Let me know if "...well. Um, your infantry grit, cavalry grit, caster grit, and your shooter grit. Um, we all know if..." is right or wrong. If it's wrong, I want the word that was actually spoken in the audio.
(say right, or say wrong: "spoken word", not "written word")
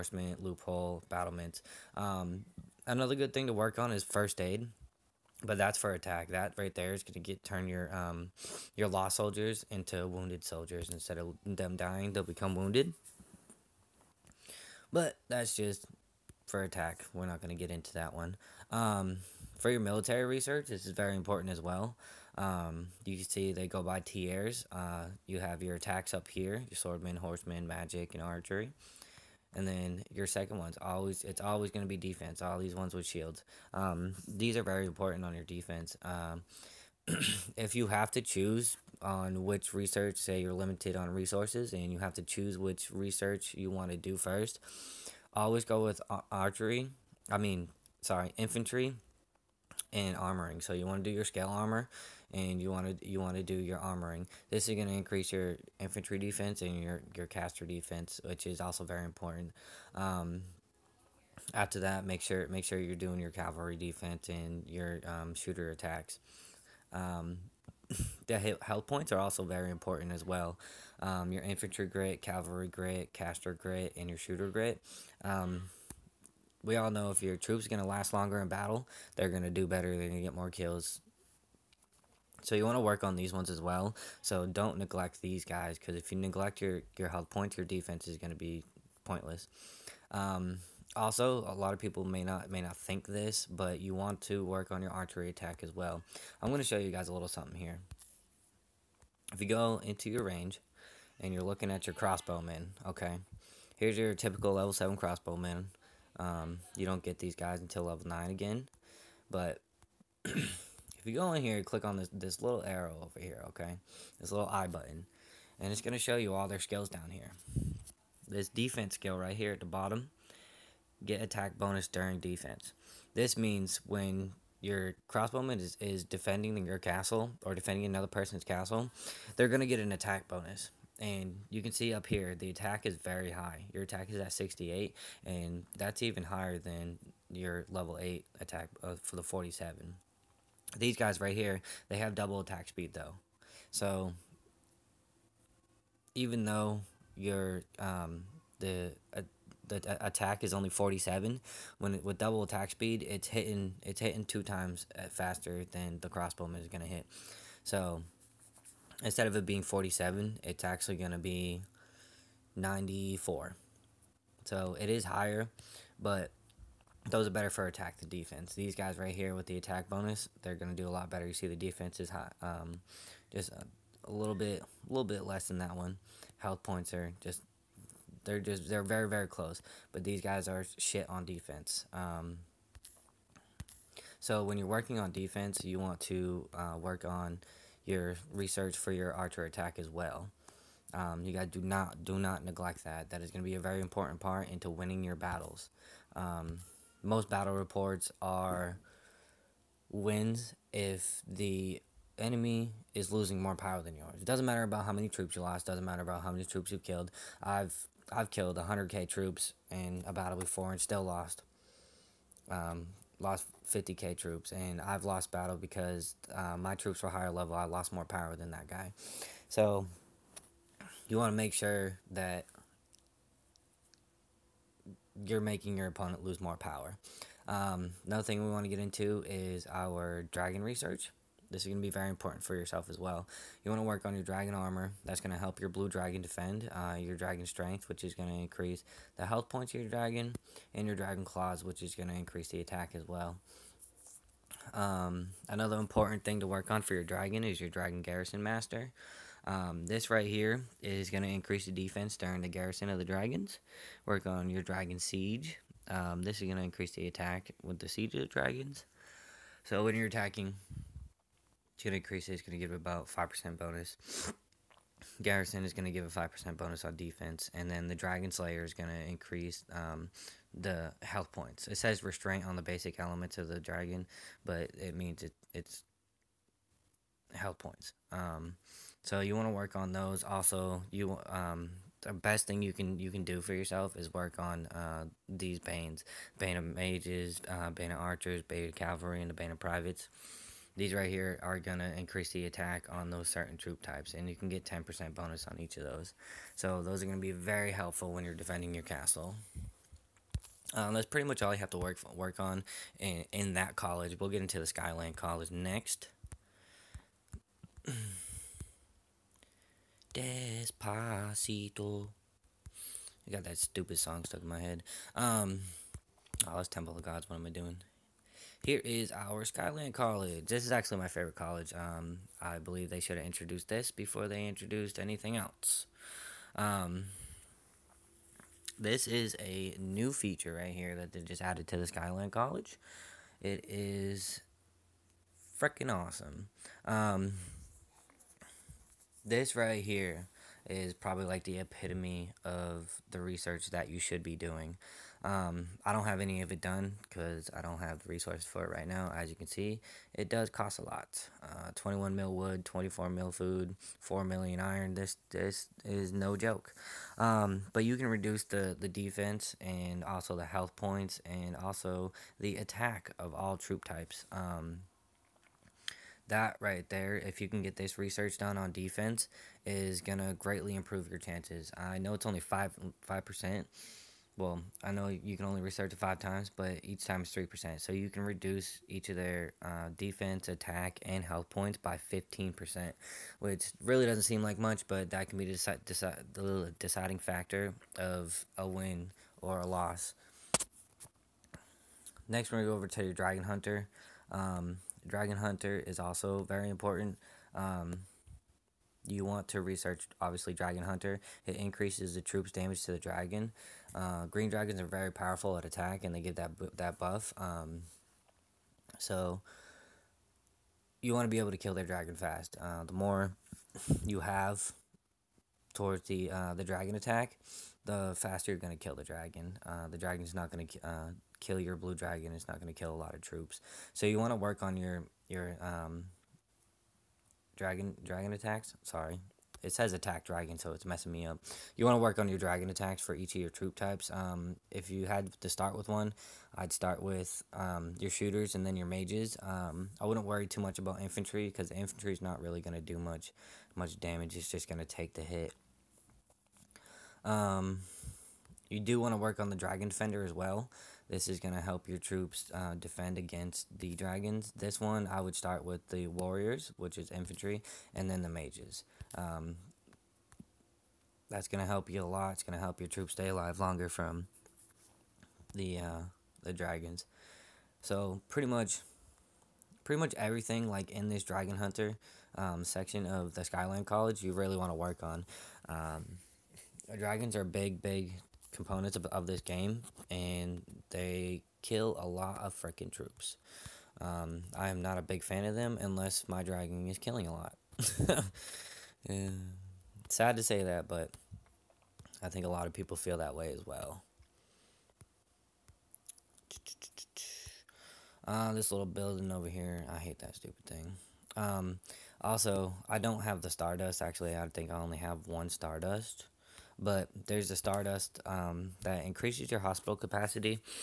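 right.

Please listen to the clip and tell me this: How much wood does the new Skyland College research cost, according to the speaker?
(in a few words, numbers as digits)
21 million.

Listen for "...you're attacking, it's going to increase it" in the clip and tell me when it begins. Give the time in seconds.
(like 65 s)
259 s.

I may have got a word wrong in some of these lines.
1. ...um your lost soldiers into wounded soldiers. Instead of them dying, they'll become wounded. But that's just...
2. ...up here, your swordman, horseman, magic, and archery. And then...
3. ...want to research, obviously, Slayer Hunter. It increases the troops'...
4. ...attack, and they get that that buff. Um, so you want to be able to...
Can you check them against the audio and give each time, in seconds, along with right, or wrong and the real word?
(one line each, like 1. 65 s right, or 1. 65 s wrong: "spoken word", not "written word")
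1. 7 s right
2. 26 s right
3. 399 s wrong: "Dragon", not "Slayer"
4. 405 s right.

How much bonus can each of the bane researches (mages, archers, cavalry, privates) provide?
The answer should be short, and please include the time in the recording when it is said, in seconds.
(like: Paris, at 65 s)
10%, at 294 s.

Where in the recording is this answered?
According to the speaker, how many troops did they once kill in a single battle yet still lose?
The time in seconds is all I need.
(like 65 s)
208 s.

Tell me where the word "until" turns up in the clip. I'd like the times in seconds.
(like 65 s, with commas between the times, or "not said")
107 s.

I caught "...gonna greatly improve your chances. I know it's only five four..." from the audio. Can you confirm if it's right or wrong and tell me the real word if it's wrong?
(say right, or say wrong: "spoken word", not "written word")
wrong: "five", not "four".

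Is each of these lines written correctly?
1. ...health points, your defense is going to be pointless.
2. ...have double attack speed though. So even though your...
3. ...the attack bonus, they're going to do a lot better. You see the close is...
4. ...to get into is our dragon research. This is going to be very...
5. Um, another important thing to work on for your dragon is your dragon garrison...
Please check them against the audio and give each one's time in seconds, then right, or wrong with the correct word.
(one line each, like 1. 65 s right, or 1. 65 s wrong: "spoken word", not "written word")
1. 87 s right
2. 141 s right
3. 169 s wrong: "defense", not "close"
4. 228 s right
5. 244 s right.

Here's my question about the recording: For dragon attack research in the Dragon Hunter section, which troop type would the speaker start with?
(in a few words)
Shooters.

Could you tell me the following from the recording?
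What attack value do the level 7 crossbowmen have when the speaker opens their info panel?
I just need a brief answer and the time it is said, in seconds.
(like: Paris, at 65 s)
68, at 134 s.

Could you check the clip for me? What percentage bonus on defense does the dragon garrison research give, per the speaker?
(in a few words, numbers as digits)
5%.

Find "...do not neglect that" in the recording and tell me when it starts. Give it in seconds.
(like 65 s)
192 s.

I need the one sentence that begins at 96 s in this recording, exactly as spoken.
I'm going to show you guys a little something here.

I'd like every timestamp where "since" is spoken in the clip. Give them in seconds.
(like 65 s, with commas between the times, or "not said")
not said.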